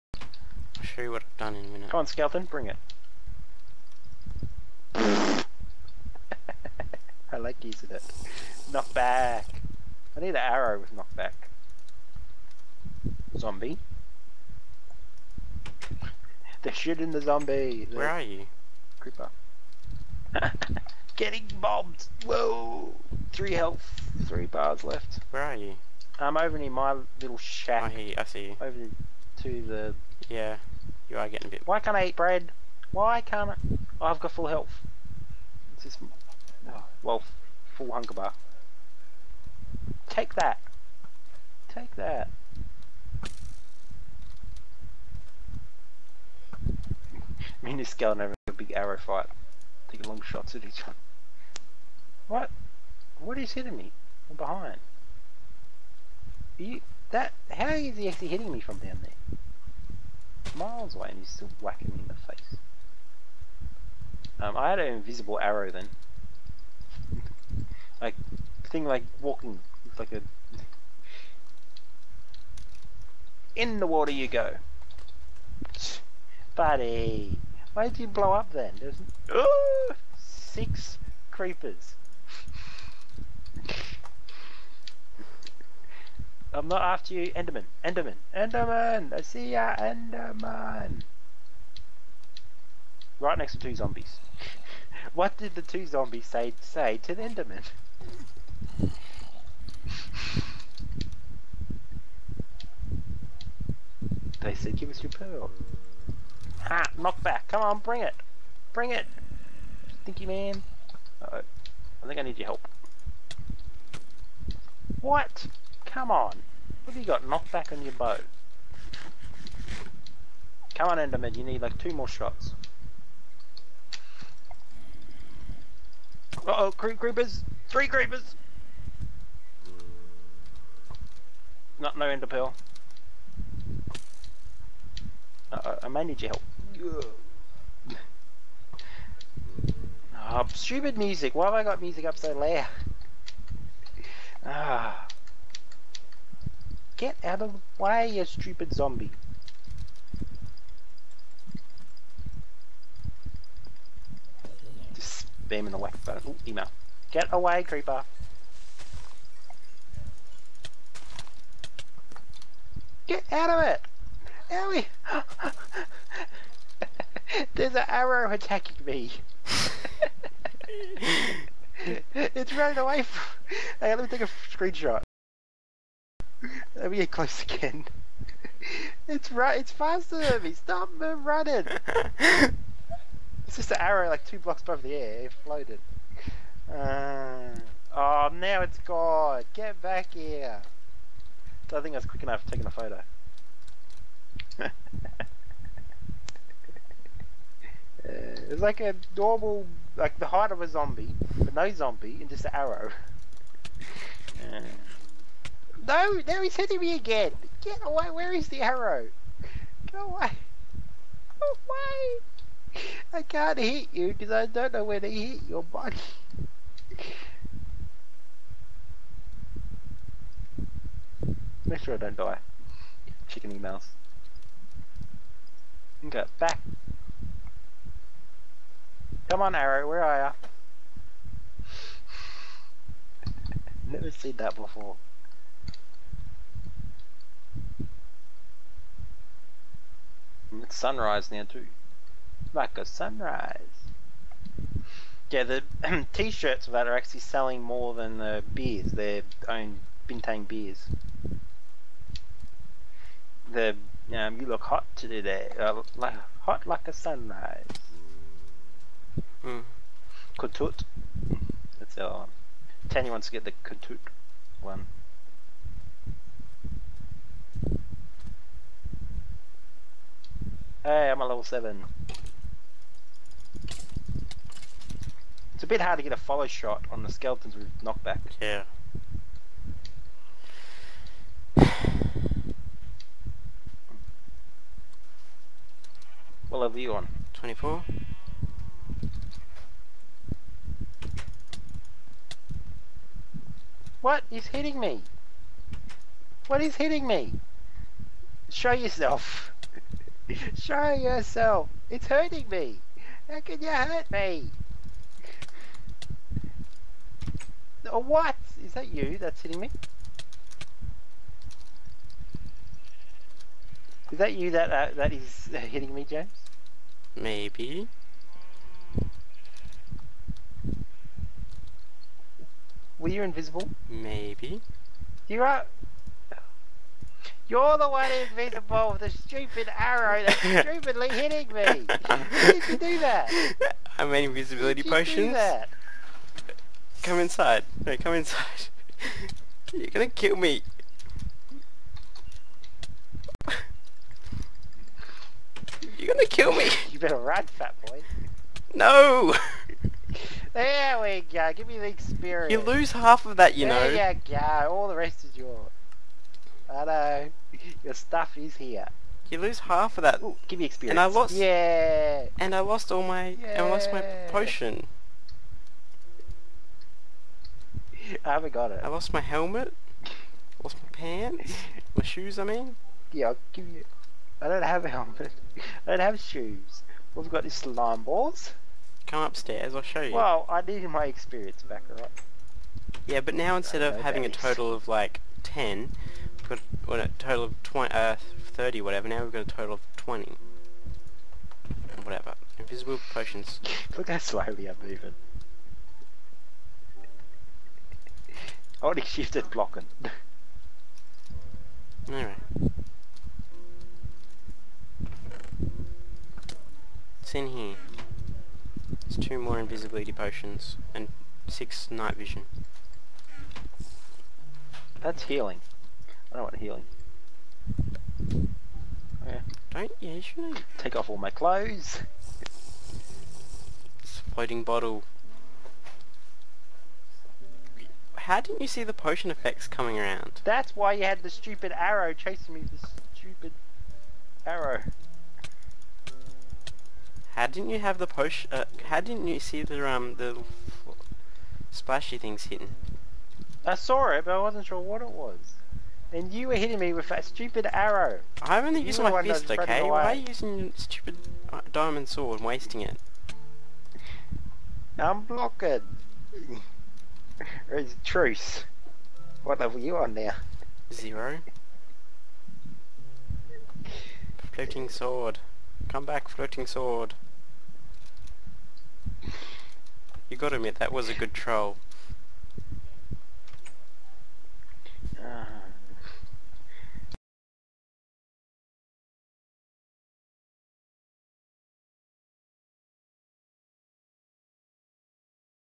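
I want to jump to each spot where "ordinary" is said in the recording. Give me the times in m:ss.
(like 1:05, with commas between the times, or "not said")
not said.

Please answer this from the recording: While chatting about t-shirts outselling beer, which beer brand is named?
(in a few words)
Bintang.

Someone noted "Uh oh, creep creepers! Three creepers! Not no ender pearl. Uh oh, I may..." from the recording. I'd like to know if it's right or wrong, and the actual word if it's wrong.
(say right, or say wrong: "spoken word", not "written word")
right.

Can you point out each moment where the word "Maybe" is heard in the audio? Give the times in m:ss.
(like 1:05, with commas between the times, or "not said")
5:17, 5:23.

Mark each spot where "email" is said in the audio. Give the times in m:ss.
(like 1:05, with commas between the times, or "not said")
2:36, 3:43.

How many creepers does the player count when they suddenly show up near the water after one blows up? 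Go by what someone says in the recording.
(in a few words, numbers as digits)
6.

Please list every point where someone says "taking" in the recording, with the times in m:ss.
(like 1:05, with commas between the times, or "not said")
0:49, 3:12.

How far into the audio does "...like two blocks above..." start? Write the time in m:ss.
3:04.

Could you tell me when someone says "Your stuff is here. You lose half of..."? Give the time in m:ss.
5:57.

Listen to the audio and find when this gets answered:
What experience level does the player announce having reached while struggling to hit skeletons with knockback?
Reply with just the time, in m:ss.
4:31.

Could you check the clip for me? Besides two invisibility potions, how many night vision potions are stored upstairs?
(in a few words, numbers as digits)
6.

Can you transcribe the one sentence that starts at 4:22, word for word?
Tanya wants to get the Kutut one.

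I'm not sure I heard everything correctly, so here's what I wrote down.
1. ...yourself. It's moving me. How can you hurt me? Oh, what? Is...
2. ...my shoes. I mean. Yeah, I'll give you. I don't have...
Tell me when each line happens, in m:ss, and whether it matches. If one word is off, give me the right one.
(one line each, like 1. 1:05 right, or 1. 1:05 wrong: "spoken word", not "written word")
1. 5:00 wrong: "hurting", not "moving"
2. 6:11 right.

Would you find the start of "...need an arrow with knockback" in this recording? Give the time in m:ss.
0:10.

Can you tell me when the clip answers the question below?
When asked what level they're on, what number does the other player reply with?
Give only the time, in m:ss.
4:47.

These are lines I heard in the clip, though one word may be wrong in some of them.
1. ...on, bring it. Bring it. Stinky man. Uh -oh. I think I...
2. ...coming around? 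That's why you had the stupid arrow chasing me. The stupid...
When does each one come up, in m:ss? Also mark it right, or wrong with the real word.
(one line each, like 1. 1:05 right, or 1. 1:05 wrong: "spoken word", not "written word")
1. 1:47 right
2. 7:09 right.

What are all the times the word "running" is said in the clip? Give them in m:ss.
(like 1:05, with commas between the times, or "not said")
2:52, 3:00.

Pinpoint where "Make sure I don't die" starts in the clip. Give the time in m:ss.
3:41.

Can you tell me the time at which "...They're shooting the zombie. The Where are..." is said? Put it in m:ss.
0:16.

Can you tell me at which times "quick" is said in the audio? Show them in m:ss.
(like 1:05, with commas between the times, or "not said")
3:12.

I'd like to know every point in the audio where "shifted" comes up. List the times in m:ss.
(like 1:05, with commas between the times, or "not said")
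6:39.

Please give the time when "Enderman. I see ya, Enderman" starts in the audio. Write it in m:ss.
1:28.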